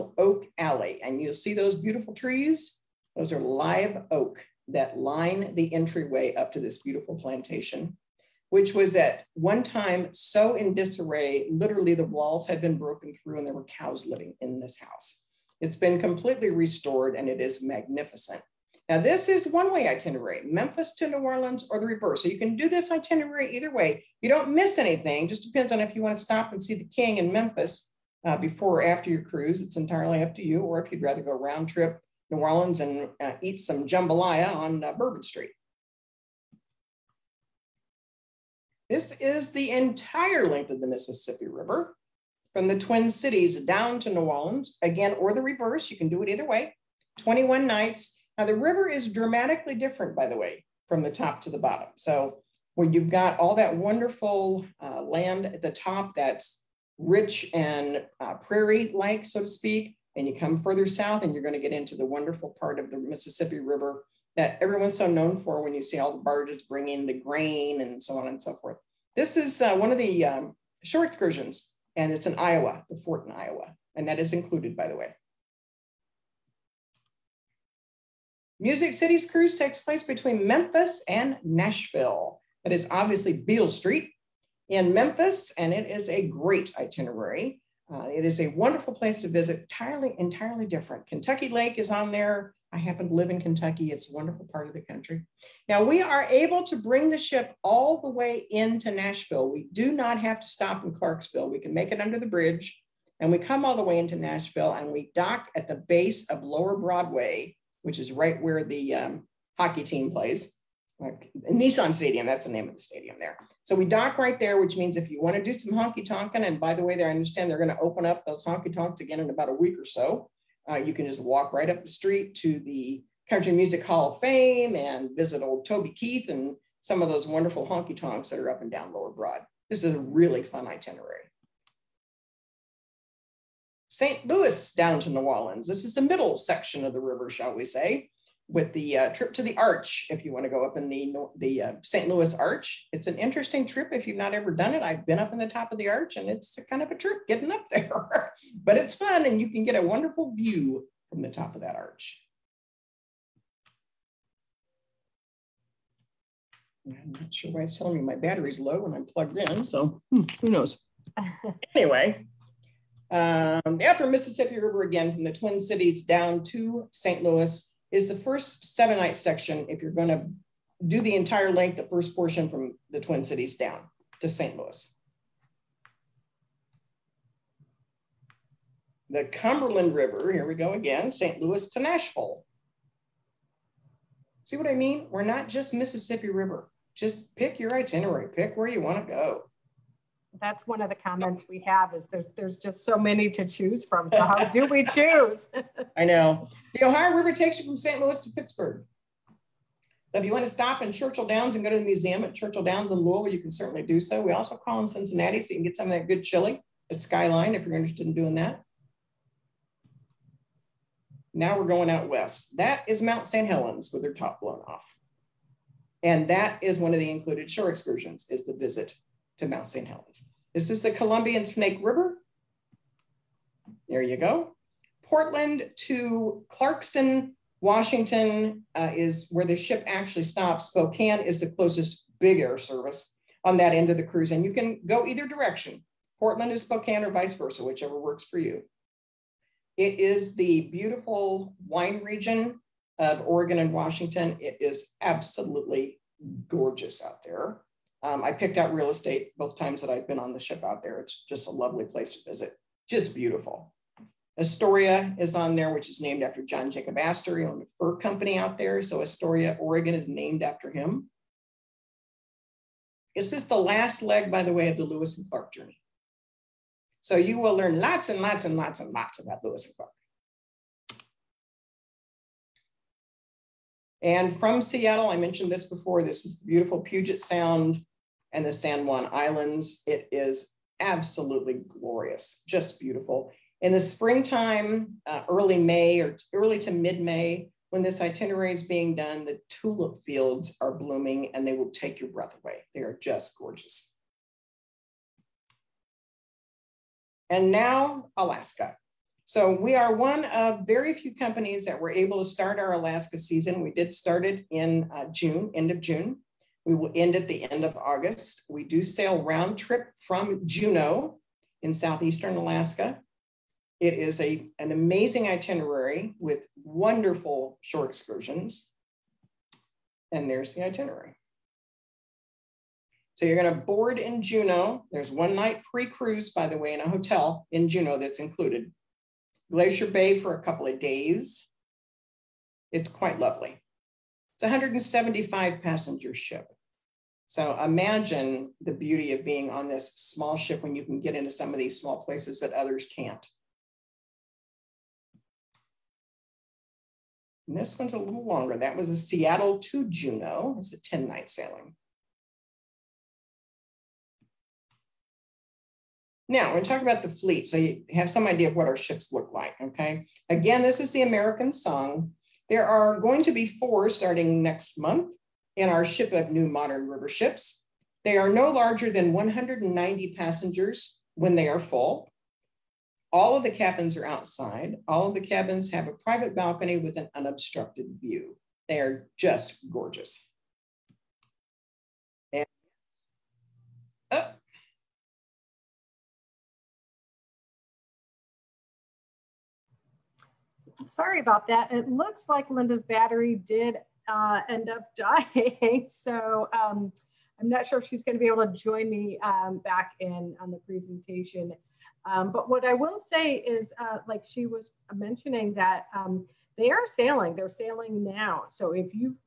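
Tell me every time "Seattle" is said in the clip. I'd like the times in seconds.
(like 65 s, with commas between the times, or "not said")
274 s, 348 s.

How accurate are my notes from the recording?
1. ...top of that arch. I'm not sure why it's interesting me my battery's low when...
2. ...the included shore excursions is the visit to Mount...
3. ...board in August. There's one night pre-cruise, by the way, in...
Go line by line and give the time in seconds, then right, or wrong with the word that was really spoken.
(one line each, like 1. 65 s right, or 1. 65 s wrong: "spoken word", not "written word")
1. 151 s wrong: "telling", not "interesting"
2. 216 s right
3. 323 s wrong: "Juneau", not "August".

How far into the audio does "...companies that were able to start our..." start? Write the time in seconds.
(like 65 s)
301 s.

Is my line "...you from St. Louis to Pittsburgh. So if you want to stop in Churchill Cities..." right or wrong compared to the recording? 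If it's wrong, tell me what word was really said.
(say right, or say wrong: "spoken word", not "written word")
wrong: "Downs", not "Cities".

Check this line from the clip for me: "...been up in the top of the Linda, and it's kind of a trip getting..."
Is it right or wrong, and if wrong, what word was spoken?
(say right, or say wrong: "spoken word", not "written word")
wrong: "Arch", not "Linda".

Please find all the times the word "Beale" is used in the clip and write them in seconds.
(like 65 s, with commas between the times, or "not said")
83 s.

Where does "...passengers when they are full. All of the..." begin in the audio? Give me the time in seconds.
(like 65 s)
370 s.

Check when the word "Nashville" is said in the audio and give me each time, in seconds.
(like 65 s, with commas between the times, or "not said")
81 s, 98 s, 104 s, 181 s.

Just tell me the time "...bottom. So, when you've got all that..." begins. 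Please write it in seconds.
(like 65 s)
51 s.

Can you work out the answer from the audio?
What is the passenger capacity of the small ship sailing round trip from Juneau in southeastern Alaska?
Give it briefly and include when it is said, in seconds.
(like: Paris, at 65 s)
175, at 334 s.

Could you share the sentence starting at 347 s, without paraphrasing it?
And this one's a little longer.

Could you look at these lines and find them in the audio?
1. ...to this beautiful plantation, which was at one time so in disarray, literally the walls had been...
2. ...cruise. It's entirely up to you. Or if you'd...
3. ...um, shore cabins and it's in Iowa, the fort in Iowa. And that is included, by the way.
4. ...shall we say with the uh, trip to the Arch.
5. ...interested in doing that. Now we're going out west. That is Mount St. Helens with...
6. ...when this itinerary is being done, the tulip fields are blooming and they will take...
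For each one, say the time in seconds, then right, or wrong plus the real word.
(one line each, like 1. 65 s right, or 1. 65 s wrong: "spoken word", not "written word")
1. 6 s right
2. 29 s right
3. 70 s wrong: "excursions", not "cabins"
4. 137 s right
5. 207 s right
6. 287 s right.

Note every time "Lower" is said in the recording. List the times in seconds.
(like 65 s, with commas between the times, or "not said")
106 s, 128 s.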